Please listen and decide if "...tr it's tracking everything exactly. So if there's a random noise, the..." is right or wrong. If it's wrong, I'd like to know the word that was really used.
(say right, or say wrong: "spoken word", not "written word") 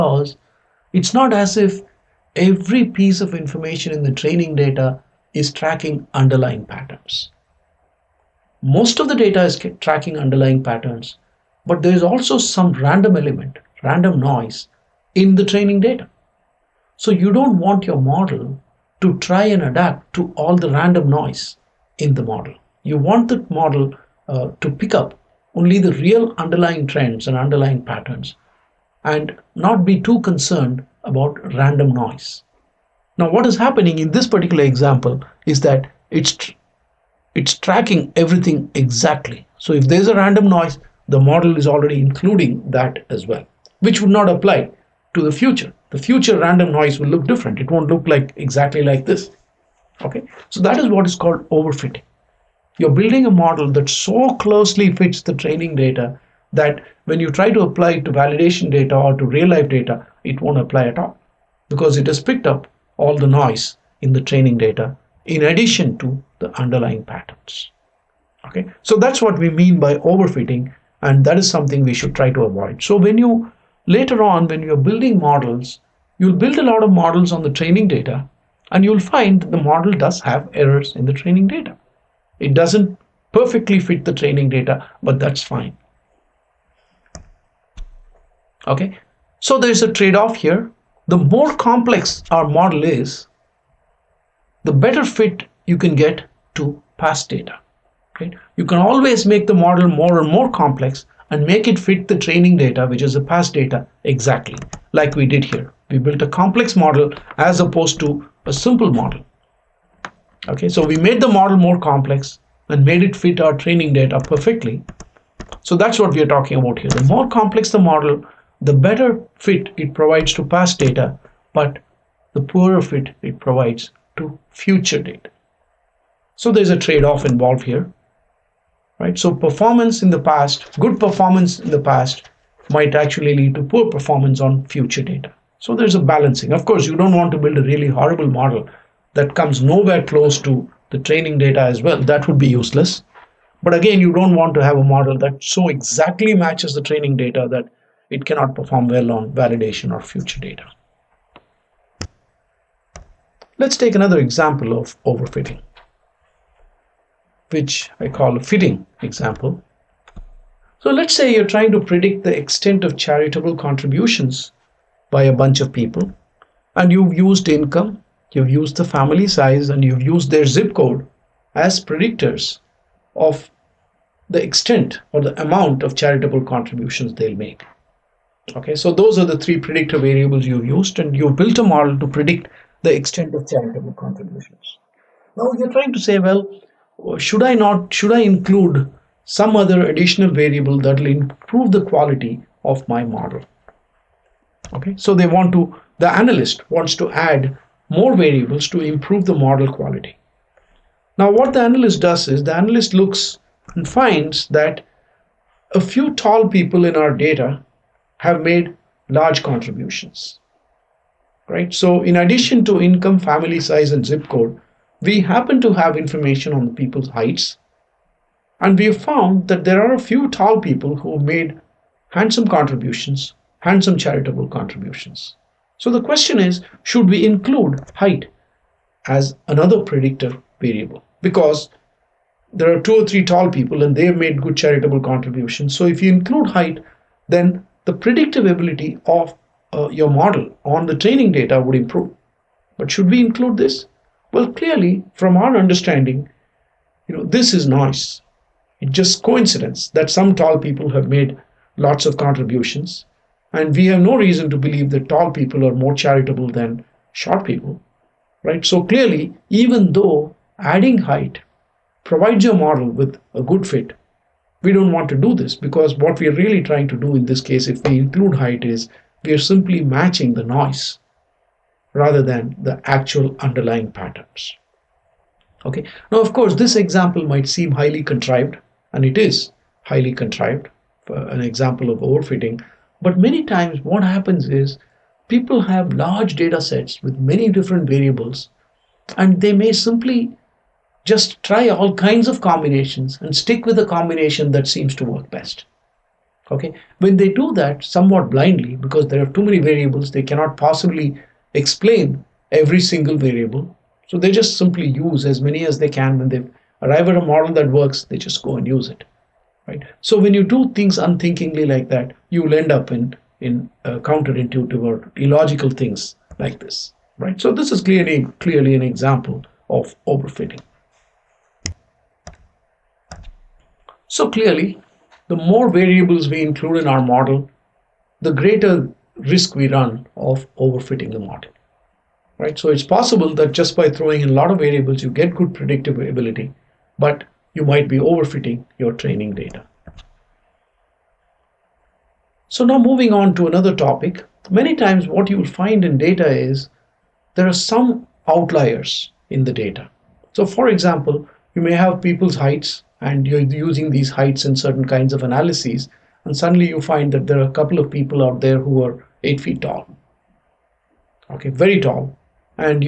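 right.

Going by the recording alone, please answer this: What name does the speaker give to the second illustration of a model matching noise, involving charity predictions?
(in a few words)
fitting example.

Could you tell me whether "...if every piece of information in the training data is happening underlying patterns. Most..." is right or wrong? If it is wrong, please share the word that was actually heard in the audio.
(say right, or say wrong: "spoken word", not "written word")
wrong: "tracking", not "happening".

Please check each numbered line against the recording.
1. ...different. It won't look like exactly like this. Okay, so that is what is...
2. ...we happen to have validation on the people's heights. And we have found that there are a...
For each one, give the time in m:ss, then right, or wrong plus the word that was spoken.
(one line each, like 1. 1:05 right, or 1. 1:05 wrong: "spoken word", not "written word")
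1. 0:47 right
2. 3:35 wrong: "information", not "validation".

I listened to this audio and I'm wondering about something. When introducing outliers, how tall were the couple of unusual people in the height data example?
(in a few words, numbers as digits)
8 feet.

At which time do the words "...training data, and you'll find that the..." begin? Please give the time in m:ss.
1:17.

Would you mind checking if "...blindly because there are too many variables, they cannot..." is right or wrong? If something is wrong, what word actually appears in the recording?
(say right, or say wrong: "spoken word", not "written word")
right.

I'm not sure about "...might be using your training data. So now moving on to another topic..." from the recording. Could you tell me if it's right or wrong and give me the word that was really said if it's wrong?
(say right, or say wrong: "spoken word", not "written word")
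wrong: "overfitting", not "using".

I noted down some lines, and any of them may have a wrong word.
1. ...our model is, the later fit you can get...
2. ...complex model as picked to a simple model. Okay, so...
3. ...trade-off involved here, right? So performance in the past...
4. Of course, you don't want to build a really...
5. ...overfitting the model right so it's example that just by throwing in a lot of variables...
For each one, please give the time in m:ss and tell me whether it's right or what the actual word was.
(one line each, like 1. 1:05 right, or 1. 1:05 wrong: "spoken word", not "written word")
1. 1:32 wrong: "better", not "later"
2. 1:46 wrong: "opposed", not "picked"
3. 2:06 right
4. 2:16 right
5. 5:30 wrong: "possible", not "example".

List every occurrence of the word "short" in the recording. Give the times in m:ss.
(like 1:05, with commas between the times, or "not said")
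4:17.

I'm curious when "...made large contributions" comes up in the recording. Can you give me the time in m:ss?
3:28.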